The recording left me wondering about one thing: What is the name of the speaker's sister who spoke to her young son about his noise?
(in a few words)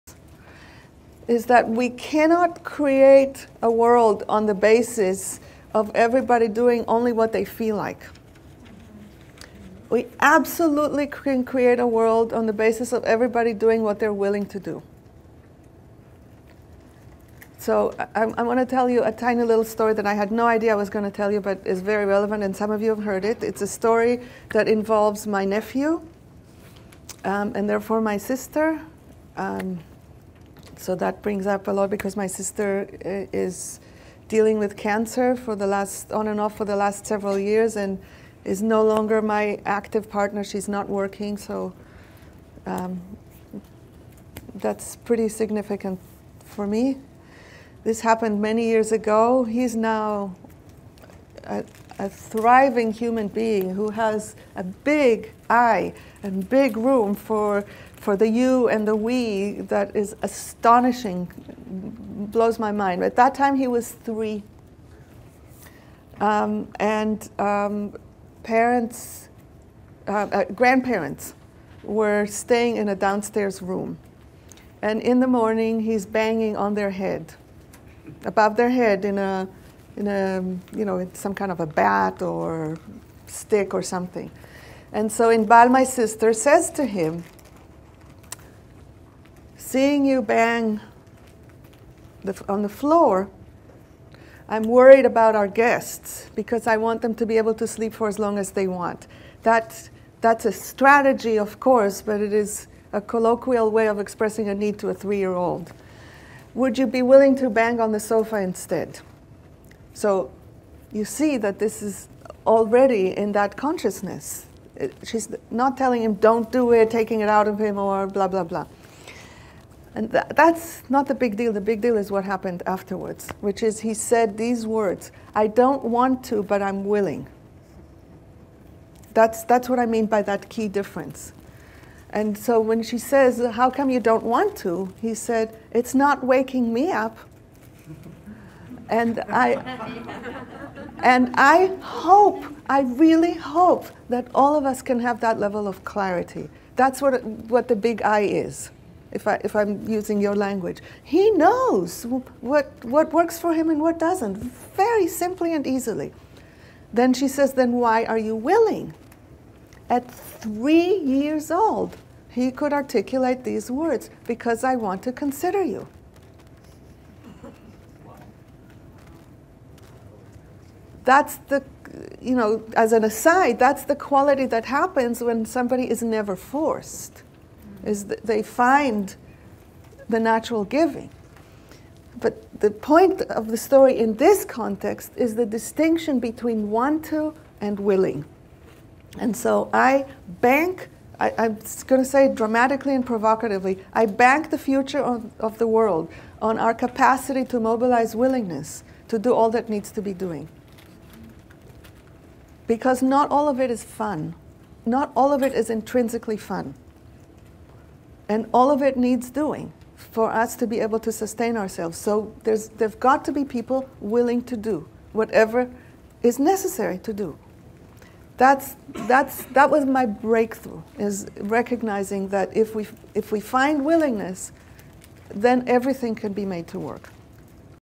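Inbal.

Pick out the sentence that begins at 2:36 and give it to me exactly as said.
Then she says, Then why are you willing?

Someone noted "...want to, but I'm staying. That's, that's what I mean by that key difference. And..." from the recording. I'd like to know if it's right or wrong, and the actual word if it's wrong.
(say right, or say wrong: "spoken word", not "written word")
wrong: "willing", not "staying".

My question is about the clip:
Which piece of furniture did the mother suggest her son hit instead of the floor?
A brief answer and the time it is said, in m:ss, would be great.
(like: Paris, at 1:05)
The sofa, at 1:48.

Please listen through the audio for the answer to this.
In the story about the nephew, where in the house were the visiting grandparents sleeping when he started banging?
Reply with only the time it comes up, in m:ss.
1:12.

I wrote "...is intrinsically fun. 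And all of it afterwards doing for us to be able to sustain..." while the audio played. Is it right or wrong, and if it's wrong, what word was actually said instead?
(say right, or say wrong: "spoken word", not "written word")
wrong: "needs", not "afterwards".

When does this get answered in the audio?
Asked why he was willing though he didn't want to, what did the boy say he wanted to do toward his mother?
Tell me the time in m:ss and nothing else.
2:45.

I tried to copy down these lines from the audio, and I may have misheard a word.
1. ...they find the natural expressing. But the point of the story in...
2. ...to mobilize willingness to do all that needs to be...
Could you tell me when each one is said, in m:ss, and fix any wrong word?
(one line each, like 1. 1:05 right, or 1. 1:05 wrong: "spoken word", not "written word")
1. 2:58 wrong: "giving", not "expressing"
2. 3:17 right.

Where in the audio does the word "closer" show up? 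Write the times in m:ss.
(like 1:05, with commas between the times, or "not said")
not said.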